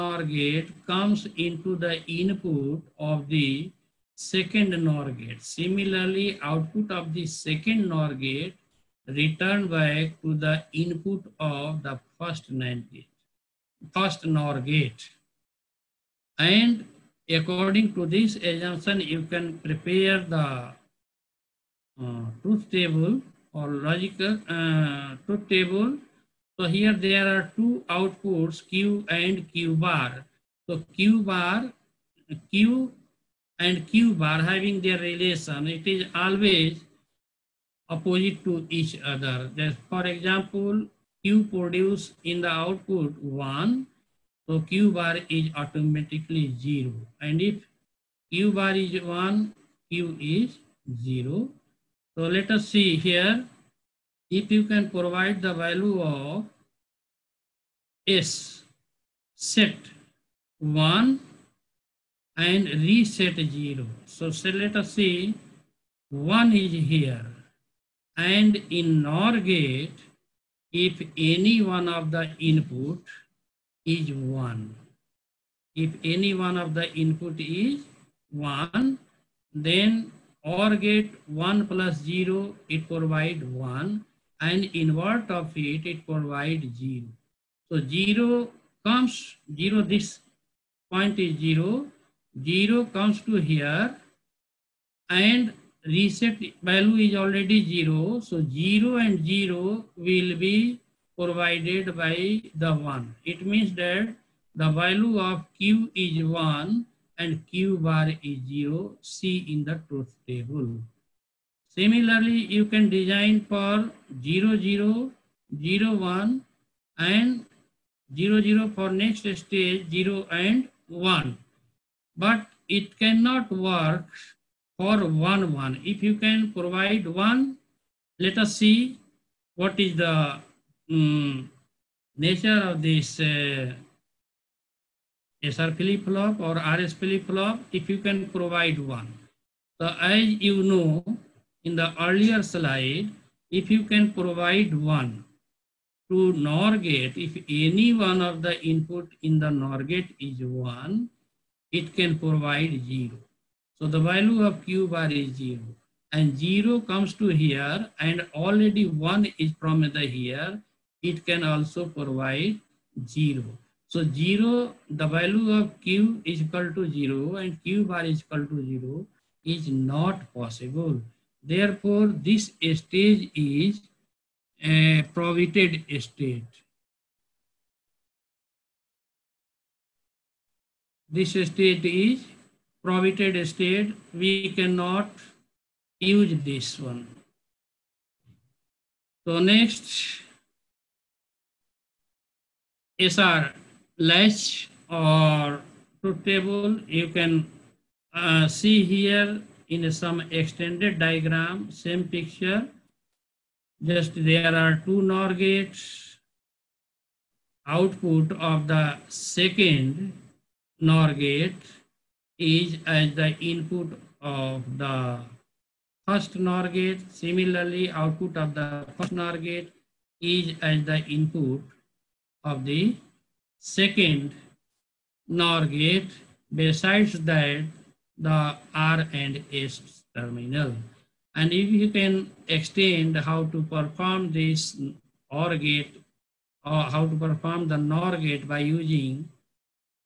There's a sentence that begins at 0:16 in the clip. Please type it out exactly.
And according to this assumption, you can prepare the uh, truth table or logical uh, truth table.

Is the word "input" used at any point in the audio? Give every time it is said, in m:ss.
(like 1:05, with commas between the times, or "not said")
0:02, 0:10, 1:12, 1:16, 2:28, 3:33, 3:41.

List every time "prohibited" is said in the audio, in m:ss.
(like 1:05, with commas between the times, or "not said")
2:55, 3:02.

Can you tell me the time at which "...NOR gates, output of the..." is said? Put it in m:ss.
3:25.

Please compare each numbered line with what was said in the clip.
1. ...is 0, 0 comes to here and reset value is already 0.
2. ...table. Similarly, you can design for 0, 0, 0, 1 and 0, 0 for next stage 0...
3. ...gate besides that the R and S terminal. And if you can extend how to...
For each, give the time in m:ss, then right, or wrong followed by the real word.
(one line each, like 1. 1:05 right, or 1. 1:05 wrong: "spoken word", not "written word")
1. 1:31 right
2. 1:50 right
3. 3:45 right.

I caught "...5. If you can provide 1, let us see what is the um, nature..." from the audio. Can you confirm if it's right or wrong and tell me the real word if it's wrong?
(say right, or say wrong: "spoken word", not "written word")
wrong: "1", not "5".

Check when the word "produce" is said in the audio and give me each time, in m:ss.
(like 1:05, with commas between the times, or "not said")
0:41.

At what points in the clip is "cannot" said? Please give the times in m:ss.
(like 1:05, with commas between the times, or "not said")
2:02, 3:04.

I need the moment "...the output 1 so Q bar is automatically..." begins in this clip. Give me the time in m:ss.
0:42.